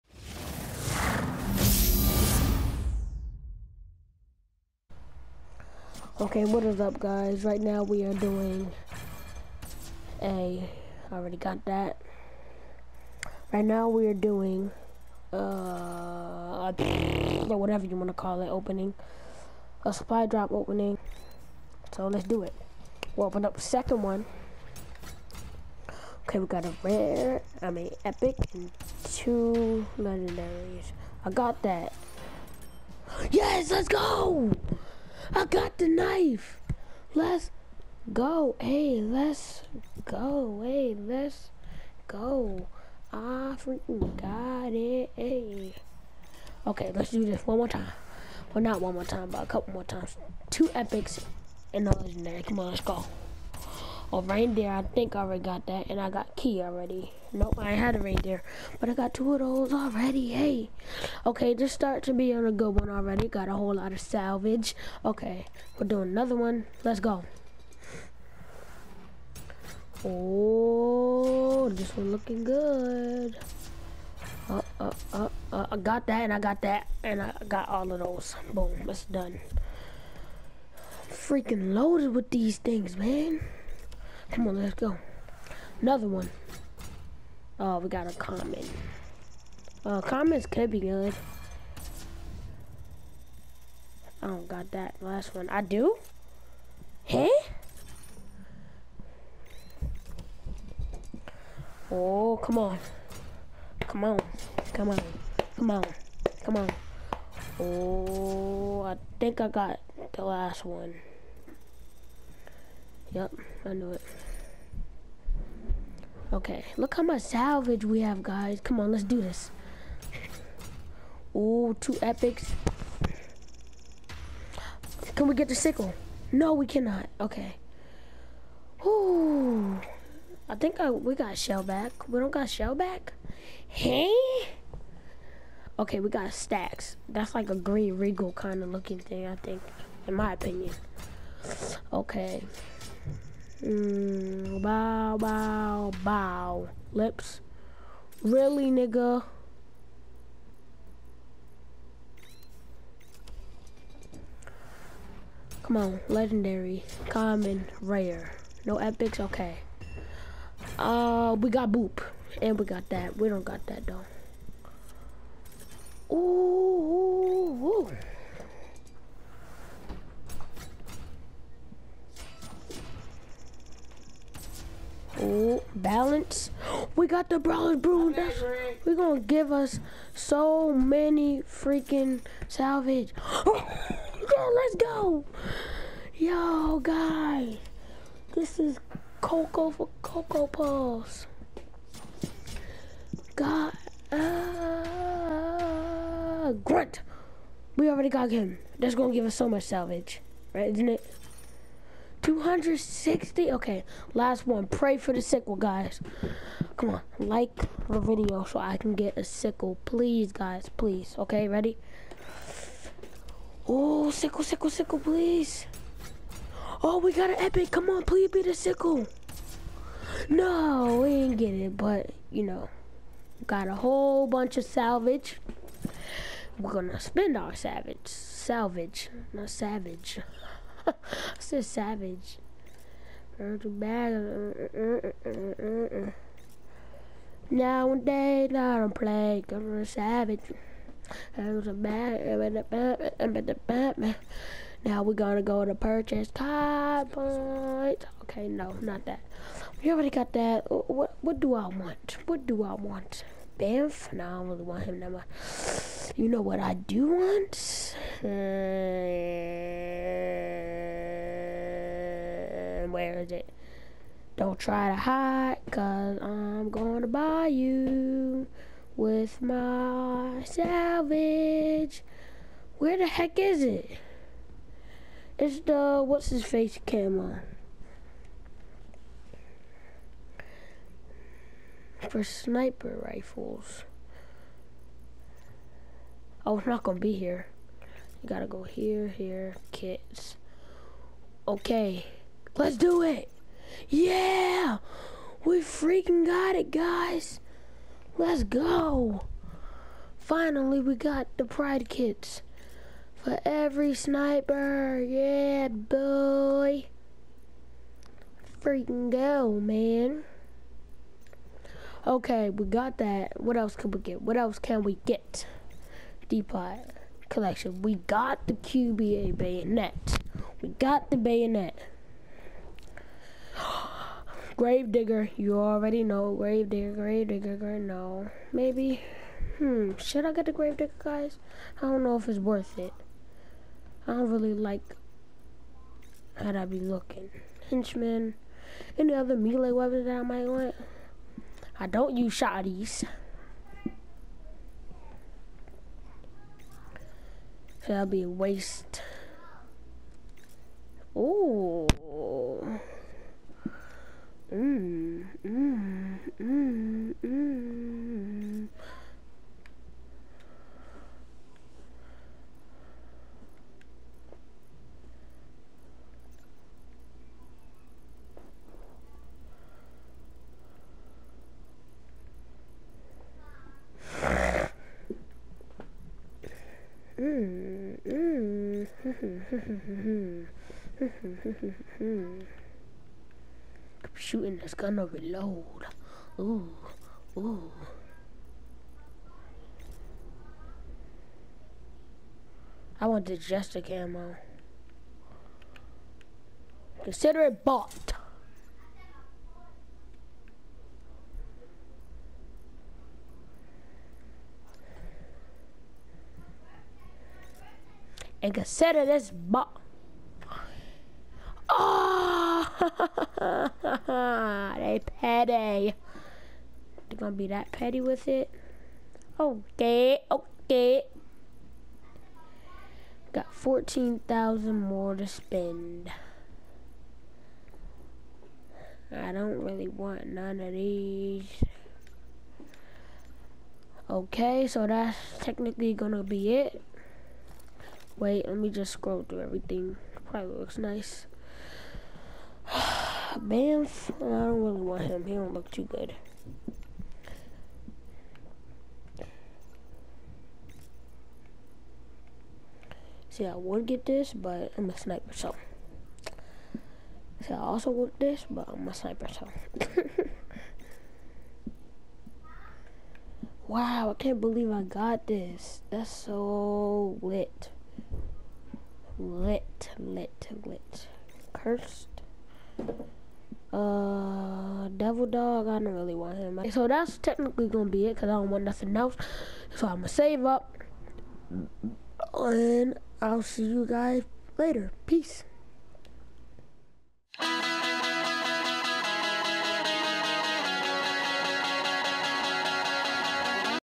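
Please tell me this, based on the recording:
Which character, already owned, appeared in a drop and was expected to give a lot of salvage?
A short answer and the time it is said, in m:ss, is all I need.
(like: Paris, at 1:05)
Grunt, at 3:16.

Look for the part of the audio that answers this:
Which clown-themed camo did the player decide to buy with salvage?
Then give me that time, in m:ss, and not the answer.
6:33.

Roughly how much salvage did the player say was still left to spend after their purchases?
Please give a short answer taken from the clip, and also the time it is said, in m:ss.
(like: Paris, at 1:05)
14,000, at 7:03.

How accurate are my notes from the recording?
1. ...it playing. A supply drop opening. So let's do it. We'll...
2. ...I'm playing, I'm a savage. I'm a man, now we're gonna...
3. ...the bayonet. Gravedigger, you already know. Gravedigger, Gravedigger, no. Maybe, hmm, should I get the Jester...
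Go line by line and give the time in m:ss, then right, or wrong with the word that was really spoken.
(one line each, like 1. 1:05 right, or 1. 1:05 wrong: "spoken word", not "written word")
1. 0:18 wrong: "opening", not "playing"
2. 3:58 right
3. 5:21 wrong: "Gravedigger", not "Jester".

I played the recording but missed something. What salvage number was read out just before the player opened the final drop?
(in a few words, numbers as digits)
260.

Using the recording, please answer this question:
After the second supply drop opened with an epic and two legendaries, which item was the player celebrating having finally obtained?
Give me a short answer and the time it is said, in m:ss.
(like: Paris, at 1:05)
The knife, at 0:35.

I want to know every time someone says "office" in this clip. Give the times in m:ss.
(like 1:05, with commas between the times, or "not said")
not said.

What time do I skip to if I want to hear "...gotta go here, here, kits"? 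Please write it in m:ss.
4:48.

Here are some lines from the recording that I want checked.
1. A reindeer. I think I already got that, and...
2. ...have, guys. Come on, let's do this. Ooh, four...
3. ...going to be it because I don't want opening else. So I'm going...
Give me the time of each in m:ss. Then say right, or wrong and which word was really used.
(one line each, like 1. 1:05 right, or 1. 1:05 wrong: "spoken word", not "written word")
1. 0:54 right
2. 1:58 wrong: "two", not "four"
3. 7:57 wrong: "nothing", not "opening".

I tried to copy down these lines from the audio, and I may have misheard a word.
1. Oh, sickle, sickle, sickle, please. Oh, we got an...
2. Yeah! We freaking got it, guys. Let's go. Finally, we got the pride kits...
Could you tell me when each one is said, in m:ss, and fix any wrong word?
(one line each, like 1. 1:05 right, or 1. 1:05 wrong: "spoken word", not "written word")
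1. 3:33 right
2. 4:53 right.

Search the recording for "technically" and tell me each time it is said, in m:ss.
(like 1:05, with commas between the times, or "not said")
7:15, 7:57.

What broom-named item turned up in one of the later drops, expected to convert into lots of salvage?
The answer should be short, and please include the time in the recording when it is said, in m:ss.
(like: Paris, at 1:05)
Brawler's Broom, at 2:57.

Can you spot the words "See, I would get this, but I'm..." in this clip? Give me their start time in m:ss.
7:33.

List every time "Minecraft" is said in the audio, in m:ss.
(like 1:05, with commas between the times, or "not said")
not said.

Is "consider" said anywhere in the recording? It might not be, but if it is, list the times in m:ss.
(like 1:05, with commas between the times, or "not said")
6:37, 6:48.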